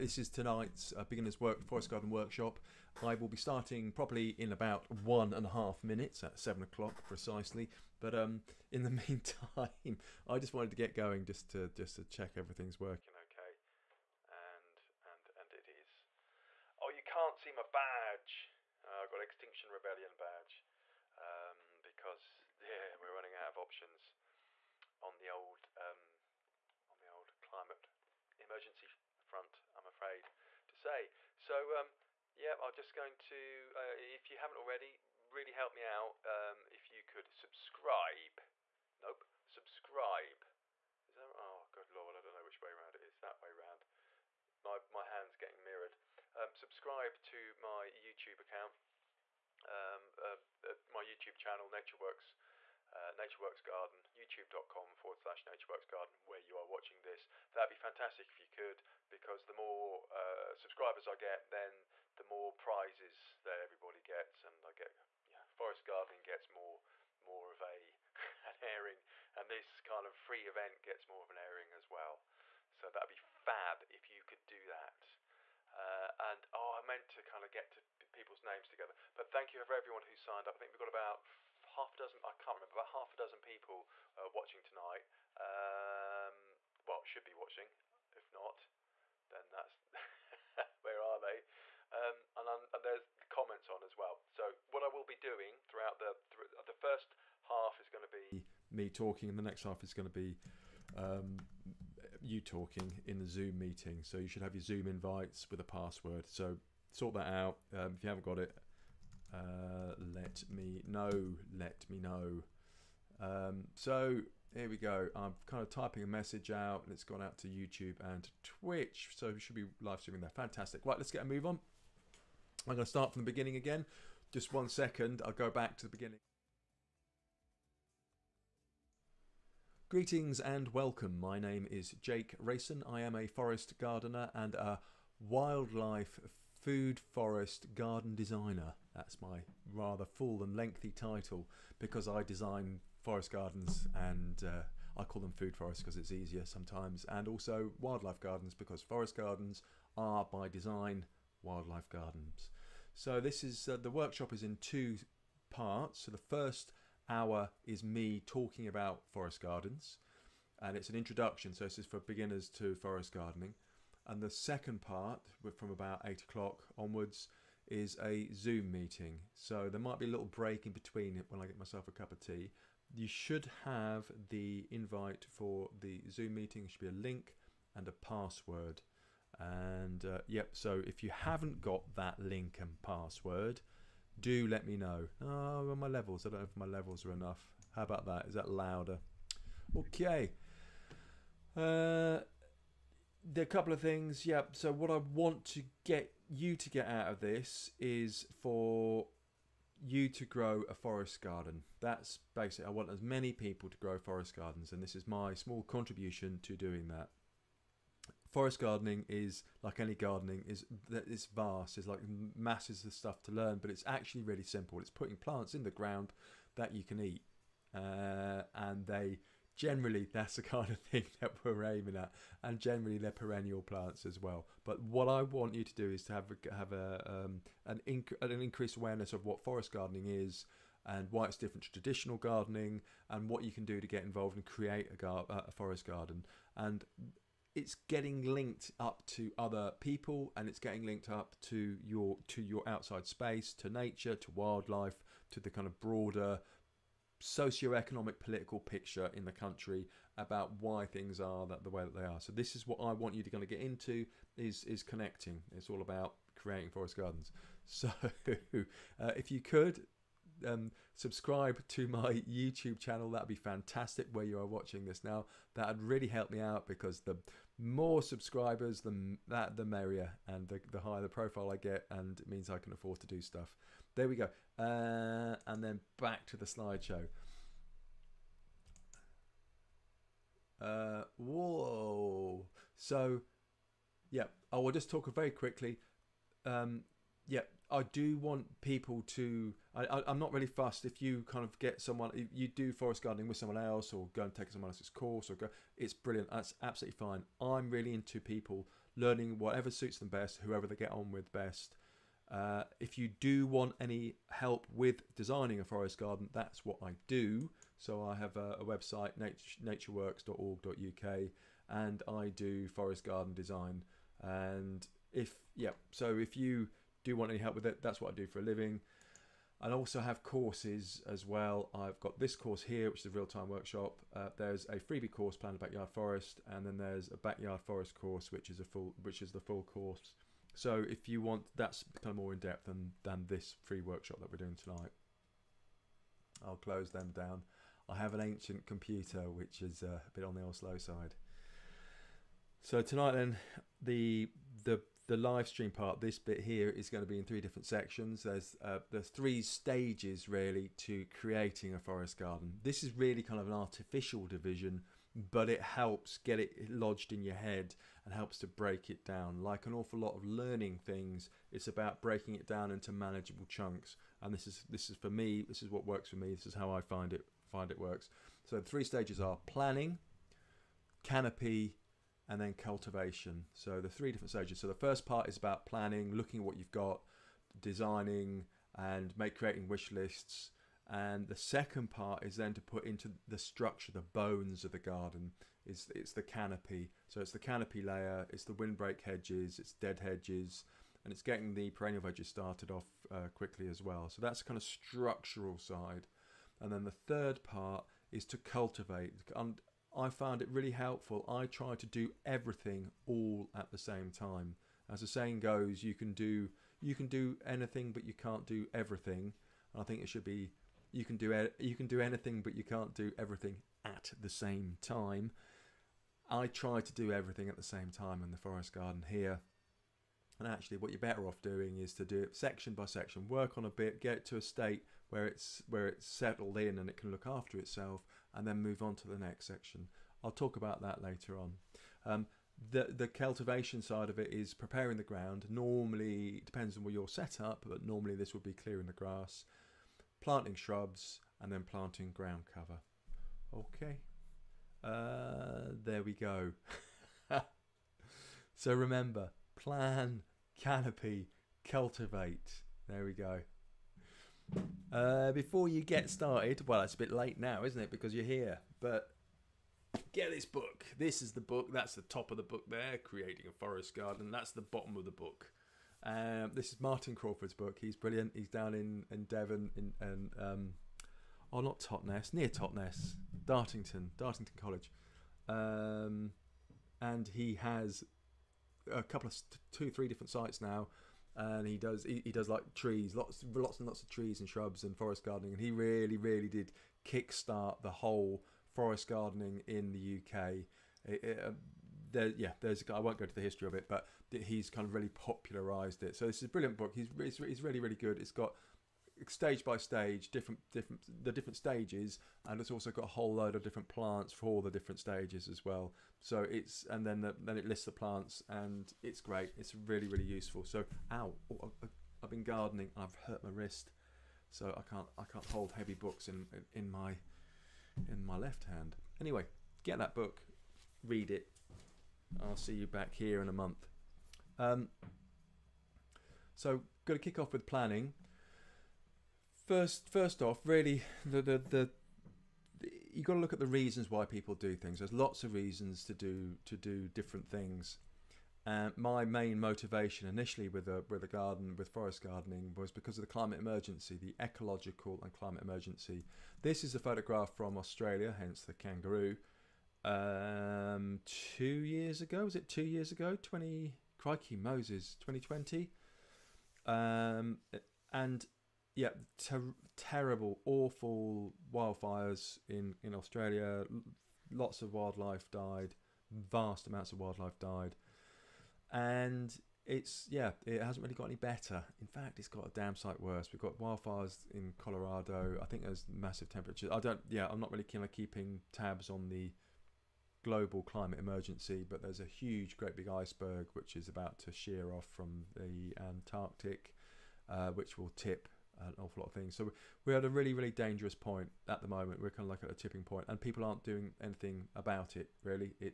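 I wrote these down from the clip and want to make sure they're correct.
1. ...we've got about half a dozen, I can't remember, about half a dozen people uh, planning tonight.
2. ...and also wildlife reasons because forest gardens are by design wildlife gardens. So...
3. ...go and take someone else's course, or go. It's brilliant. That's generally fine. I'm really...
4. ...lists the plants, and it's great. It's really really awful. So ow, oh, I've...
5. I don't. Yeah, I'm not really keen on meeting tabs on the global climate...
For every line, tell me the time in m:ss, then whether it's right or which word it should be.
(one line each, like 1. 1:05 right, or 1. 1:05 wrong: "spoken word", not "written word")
1. 1:20 wrong: "watching", not "planning"
2. 2:27 wrong: "gardens", not "reasons"
3. 4:54 wrong: "absolutely", not "generally"
4. 8:27 wrong: "useful", not "awful"
5. 9:36 wrong: "keeping", not "meeting".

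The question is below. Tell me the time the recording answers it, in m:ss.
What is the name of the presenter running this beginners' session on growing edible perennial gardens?
2:12.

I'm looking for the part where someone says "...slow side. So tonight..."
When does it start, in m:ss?
5:40.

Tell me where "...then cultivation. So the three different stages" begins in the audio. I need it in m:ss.
6:12.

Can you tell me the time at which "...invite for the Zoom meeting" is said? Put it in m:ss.
2:54.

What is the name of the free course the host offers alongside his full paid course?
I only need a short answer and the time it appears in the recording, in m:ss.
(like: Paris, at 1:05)
Plan Backyard Forest, at 5:25.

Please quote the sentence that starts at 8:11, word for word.
It, it, uh, there, yeah, there's I won't go to the history of it, but he's kind of really popularised it.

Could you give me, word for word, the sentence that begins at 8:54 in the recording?
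There's lots of reasons to do to do different things.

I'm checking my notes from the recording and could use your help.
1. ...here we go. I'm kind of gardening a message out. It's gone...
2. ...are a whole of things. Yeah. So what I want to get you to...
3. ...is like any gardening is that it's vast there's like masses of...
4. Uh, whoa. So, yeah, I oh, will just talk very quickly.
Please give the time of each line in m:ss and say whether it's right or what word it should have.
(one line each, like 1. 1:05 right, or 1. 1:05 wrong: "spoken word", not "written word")
1. 1:54 wrong: "typing", not "gardening"
2. 3:13 wrong: "couple", not "whole"
3. 3:29 right
4. 4:40 right.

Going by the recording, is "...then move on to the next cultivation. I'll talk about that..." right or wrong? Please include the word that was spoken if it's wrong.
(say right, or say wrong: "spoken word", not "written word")
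wrong: "section", not "cultivation".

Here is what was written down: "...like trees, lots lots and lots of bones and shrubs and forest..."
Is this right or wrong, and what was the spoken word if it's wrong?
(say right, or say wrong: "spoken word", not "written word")
wrong: "trees", not "bones".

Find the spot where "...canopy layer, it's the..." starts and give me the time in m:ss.
6:27.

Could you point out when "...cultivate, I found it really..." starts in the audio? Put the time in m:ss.
6:38.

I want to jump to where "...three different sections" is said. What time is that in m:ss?
5:47.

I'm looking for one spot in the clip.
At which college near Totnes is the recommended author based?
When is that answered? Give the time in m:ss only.
7:54.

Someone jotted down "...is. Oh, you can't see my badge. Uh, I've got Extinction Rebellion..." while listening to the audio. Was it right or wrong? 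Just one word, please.
right.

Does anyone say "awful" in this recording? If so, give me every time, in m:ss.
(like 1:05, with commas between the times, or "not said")
5:59, 9:20, 9:48.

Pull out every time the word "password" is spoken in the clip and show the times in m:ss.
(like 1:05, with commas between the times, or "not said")
1:45, 2:57, 3:02.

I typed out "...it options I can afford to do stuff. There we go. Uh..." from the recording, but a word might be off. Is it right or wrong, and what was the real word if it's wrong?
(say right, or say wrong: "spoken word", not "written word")
wrong: "means", not "options".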